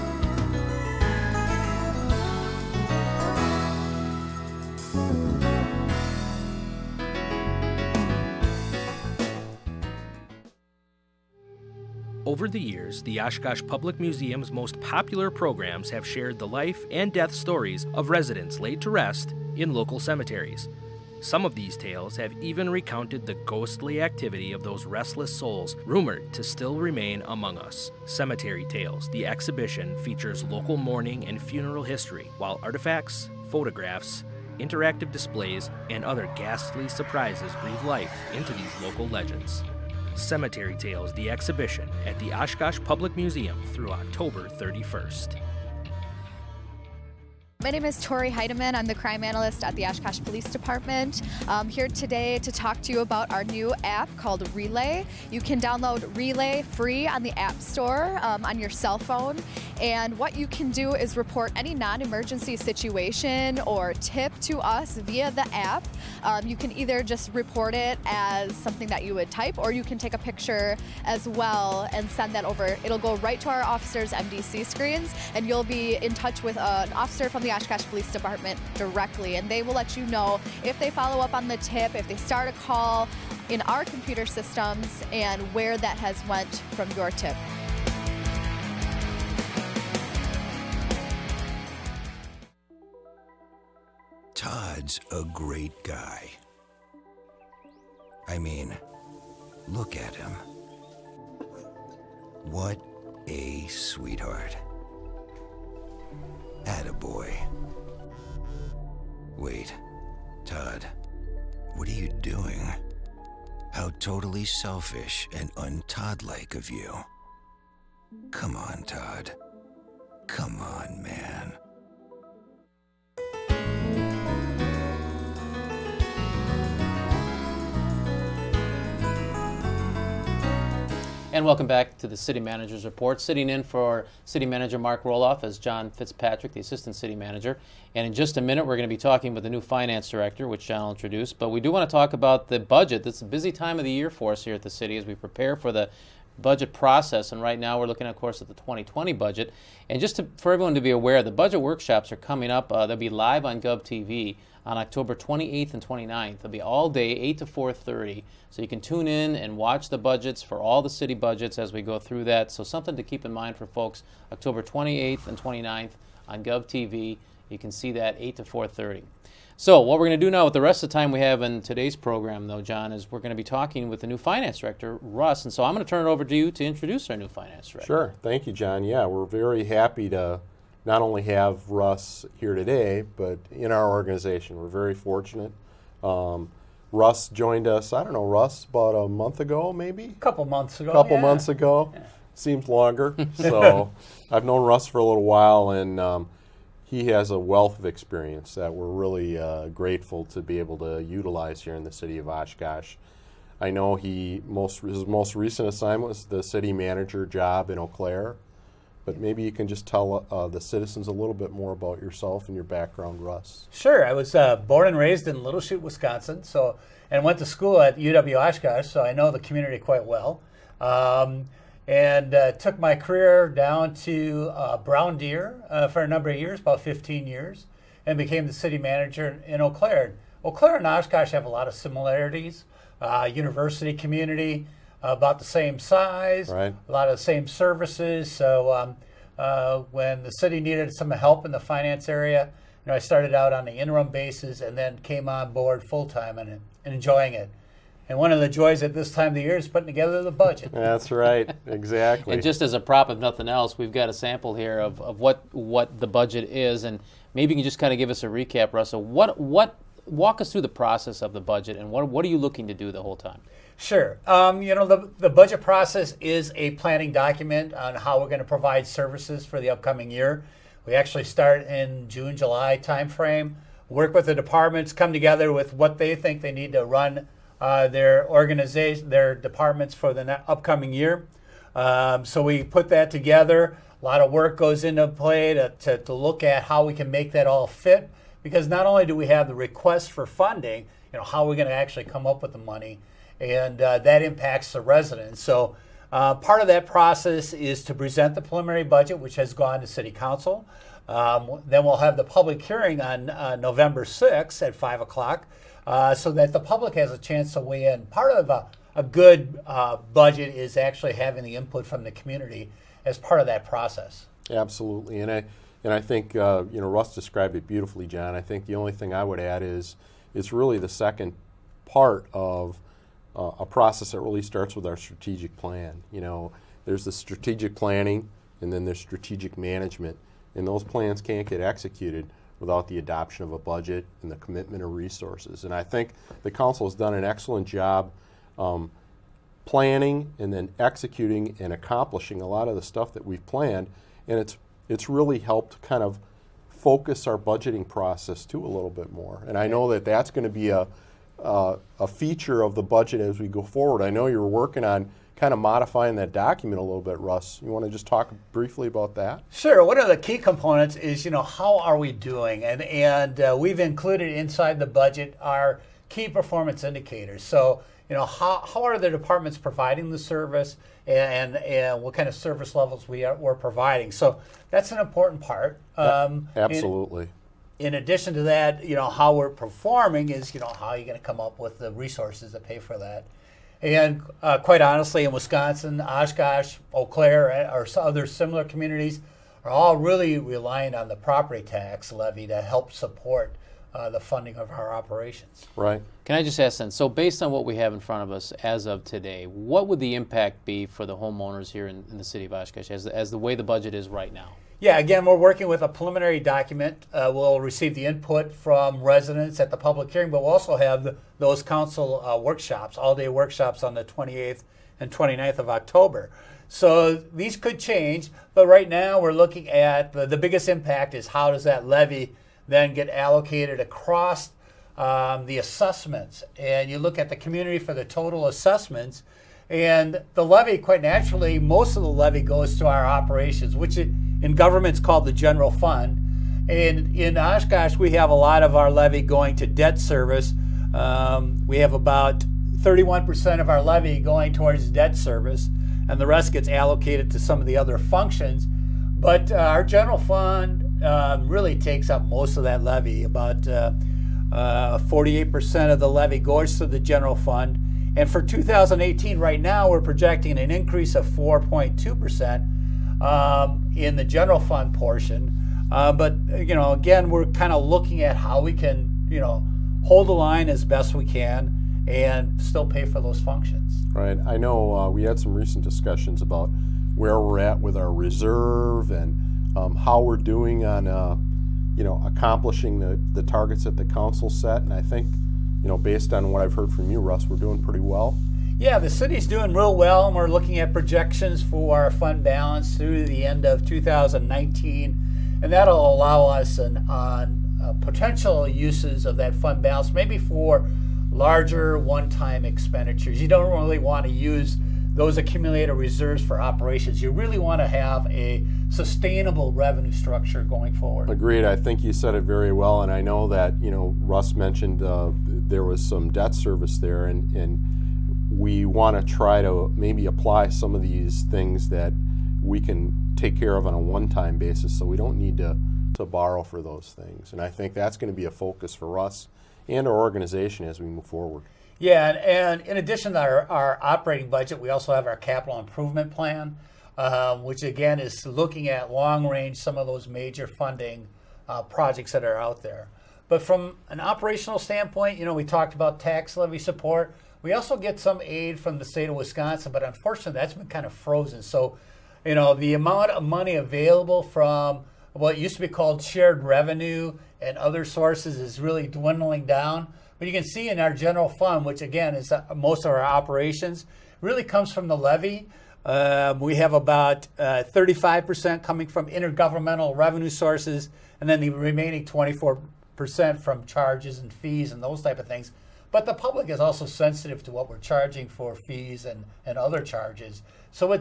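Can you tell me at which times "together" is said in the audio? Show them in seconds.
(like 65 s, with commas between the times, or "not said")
249 s, 275 s, 283 s.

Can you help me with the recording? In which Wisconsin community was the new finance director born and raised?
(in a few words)
Little Chute.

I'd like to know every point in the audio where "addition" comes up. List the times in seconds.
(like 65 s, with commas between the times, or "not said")
377 s, 532 s.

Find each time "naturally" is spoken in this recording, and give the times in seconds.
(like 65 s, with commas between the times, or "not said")
431 s.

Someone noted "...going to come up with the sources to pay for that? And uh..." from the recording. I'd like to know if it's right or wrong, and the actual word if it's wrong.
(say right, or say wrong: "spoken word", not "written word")
wrong: "resources", not "sources".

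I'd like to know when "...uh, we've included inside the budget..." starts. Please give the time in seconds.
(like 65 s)
363 s.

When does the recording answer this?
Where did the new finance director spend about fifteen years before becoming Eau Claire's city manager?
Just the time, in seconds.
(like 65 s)
224 s.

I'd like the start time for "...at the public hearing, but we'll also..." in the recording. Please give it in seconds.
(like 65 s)
409 s.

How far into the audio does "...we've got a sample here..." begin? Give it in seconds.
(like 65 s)
253 s.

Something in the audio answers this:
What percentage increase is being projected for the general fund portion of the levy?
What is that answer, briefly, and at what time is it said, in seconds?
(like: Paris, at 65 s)
4.2%, at 461 s.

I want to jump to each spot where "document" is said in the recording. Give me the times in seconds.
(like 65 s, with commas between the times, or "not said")
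267 s, 356 s, 406 s.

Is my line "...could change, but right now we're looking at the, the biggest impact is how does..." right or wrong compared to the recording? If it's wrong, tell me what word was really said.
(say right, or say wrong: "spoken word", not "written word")
right.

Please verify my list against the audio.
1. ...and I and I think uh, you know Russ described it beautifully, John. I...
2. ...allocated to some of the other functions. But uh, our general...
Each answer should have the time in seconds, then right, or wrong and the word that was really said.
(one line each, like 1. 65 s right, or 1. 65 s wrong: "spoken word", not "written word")
1. 315 s right
2. 446 s right.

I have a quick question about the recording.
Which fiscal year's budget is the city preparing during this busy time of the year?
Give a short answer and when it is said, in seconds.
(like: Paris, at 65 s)
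2020, at 148 s.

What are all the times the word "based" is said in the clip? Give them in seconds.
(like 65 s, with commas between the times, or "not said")
397 s, 485 s.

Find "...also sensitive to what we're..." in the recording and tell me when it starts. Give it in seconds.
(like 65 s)
576 s.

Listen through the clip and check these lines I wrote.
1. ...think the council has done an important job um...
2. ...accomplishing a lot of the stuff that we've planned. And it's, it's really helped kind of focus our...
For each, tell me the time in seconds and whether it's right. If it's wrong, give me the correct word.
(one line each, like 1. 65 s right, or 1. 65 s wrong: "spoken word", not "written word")
1. 335 s wrong: "excellent", not "important"
2. 341 s right.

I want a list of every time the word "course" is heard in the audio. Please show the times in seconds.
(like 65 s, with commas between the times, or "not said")
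148 s.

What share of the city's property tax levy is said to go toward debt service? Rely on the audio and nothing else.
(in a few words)
31%.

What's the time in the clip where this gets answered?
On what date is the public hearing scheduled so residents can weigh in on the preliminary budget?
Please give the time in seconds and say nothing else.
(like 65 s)
303 s.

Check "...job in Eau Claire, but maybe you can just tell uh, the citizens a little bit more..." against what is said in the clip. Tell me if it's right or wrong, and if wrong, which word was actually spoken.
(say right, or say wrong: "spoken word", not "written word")
right.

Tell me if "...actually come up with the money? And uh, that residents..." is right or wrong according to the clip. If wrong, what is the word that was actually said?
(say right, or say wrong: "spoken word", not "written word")
wrong: "impacts", not "residents".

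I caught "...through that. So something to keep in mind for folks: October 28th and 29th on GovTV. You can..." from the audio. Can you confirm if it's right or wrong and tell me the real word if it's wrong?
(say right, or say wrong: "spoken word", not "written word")
right.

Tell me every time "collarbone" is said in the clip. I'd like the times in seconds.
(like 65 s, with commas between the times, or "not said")
not said.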